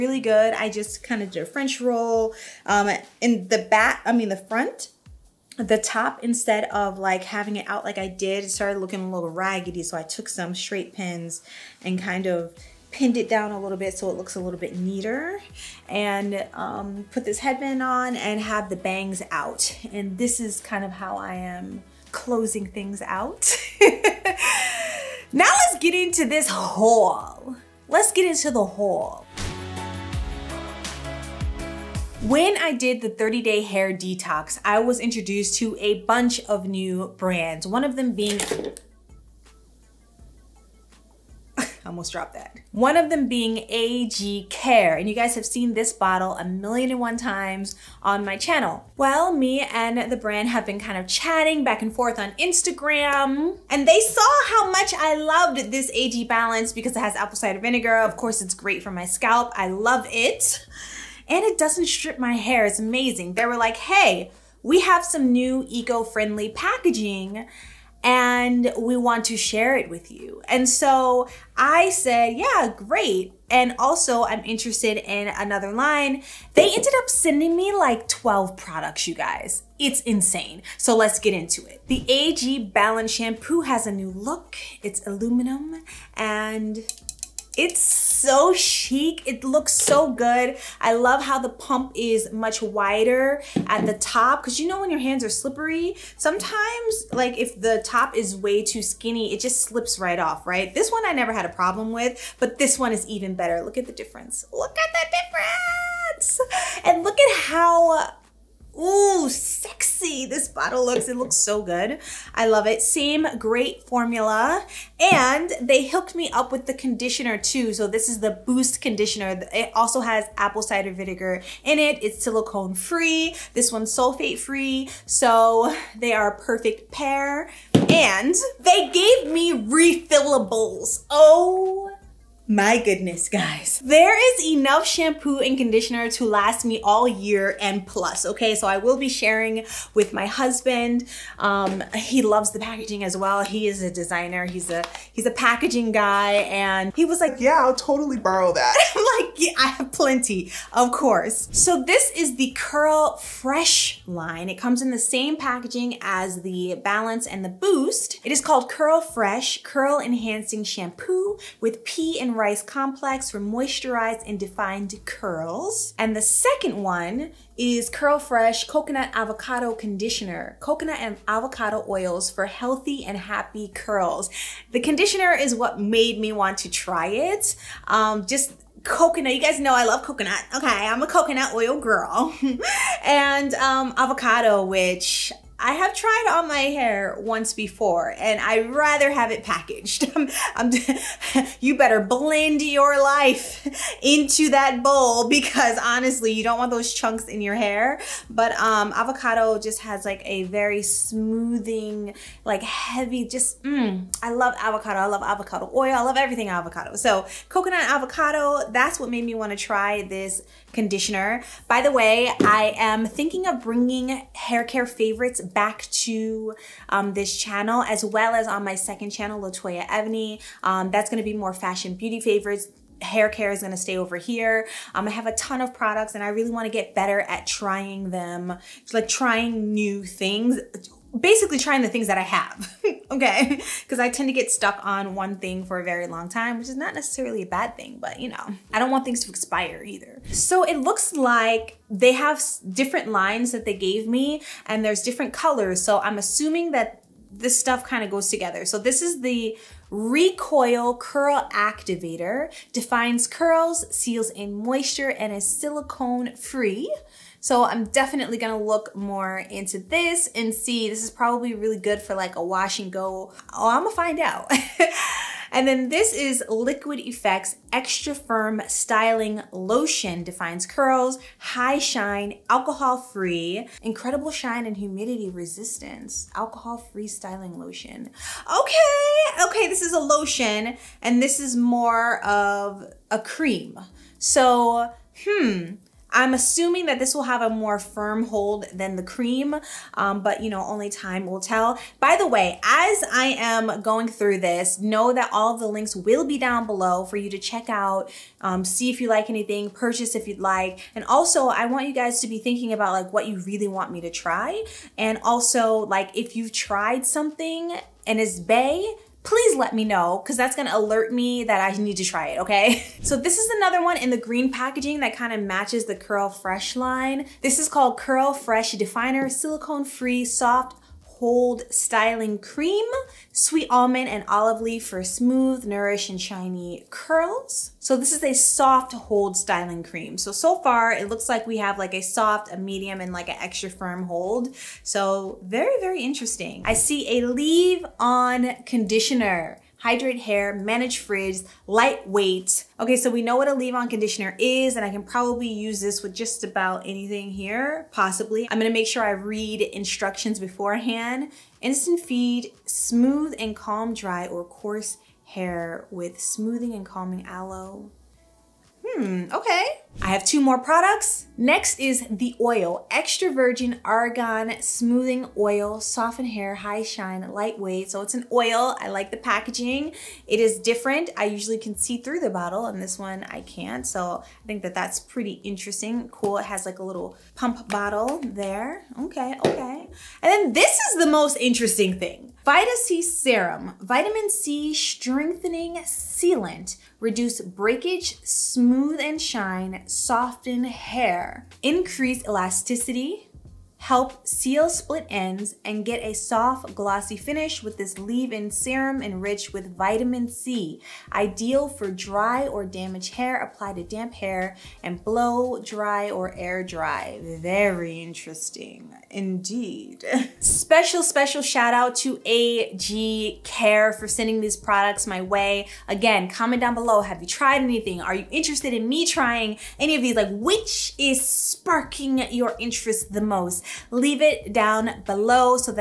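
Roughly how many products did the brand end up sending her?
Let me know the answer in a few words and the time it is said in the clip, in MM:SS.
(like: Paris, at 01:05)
12, at 01:18.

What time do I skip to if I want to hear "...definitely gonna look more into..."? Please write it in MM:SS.
04:17.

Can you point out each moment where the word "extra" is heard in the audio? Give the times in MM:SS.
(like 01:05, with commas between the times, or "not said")
04:27, 05:33, 06:02.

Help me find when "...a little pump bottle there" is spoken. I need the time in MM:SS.
06:16.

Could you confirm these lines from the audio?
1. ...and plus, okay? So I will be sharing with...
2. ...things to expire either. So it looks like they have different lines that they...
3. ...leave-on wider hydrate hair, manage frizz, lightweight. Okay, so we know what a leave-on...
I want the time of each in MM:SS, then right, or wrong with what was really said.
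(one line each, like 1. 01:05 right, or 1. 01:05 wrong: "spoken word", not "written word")
1. 02:17 right
2. 03:59 right
3. 05:37 wrong: "conditioner", not "wider".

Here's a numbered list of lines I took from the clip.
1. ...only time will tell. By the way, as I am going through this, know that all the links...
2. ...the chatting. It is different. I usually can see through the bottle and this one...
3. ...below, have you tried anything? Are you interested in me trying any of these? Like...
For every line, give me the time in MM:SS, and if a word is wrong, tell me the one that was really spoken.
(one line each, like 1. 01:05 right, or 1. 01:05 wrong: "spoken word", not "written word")
1. 04:50 right
2. 06:09 wrong: "packaging", not "chatting"
3. 06:56 right.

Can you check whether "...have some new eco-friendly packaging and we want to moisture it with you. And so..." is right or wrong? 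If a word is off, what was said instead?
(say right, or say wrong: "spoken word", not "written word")
wrong: "share", not "moisture".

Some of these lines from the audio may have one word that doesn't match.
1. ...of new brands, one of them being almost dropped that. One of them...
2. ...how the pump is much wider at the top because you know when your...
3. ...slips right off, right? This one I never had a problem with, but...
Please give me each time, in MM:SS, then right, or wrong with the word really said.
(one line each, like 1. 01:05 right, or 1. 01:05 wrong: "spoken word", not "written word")
1. 00:36 right
2. 01:31 right
3. 01:39 right.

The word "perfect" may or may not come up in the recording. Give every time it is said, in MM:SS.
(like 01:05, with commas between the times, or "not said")
02:06.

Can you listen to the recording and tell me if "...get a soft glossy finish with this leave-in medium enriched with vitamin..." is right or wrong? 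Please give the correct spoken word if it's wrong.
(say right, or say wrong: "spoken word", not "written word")
wrong: "serum", not "medium".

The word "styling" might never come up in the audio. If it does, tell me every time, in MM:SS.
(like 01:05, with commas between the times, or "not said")
04:28, 04:37, 05:21, 05:29.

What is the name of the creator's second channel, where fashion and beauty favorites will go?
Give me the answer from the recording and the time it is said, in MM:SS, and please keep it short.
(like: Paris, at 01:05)
Latoya Ebony, at 03:39.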